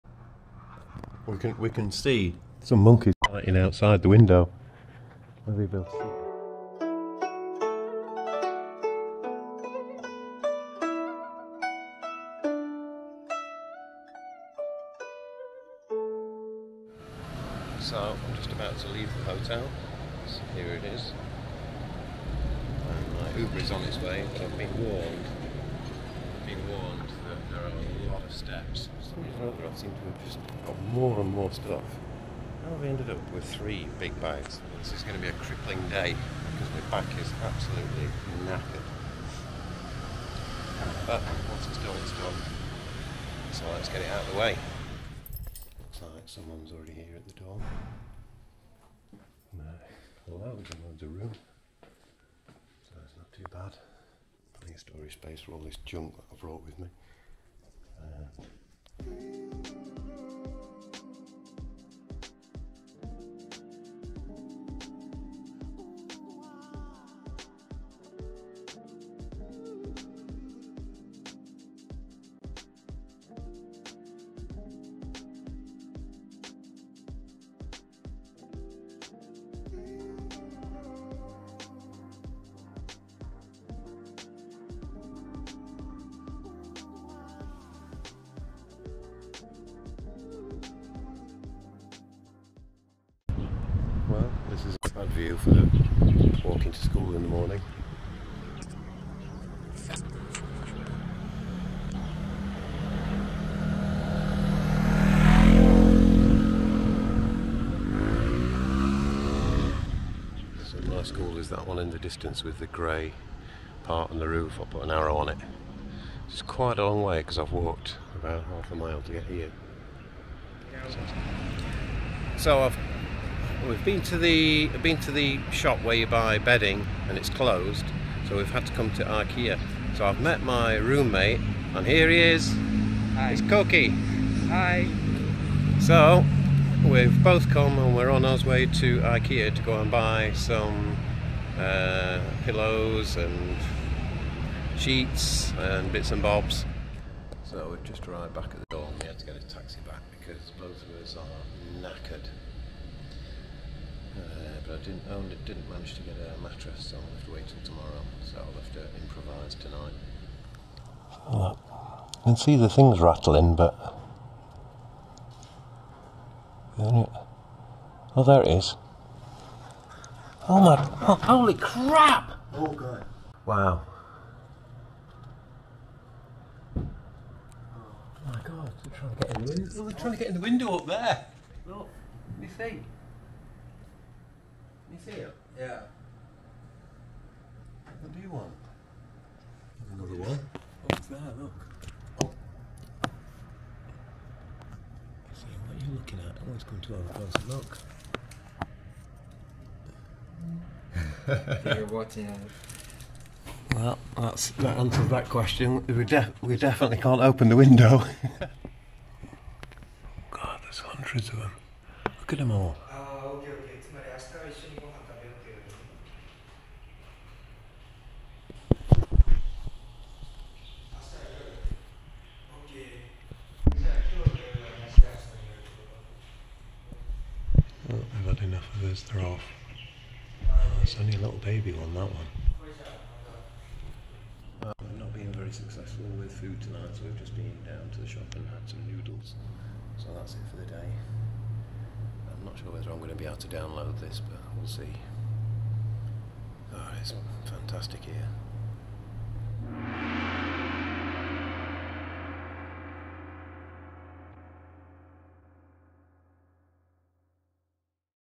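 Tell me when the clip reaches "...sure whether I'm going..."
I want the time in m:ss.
4:02.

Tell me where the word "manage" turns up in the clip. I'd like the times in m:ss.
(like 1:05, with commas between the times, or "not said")
2:35.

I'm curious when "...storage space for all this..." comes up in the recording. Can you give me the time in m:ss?
0:54.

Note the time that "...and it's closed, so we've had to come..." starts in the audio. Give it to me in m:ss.
2:07.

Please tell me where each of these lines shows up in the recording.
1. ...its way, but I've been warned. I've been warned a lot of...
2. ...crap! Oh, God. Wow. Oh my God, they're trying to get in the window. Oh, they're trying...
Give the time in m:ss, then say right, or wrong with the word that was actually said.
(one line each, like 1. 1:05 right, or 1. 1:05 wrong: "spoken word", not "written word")
1. 0:23 right
2. 2:51 right.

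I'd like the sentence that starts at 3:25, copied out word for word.
We, def we definitely can't open the window.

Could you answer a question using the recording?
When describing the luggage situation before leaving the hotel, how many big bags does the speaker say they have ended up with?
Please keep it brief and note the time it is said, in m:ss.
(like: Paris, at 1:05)
3, at 0:33.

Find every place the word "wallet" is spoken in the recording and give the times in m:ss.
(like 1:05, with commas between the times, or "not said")
not said.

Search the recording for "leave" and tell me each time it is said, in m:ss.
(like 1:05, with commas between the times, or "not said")
0:18.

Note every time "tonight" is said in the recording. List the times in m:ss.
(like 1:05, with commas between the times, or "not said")
2:39, 3:56.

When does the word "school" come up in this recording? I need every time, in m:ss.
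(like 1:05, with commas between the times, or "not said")
1:36, 1:51.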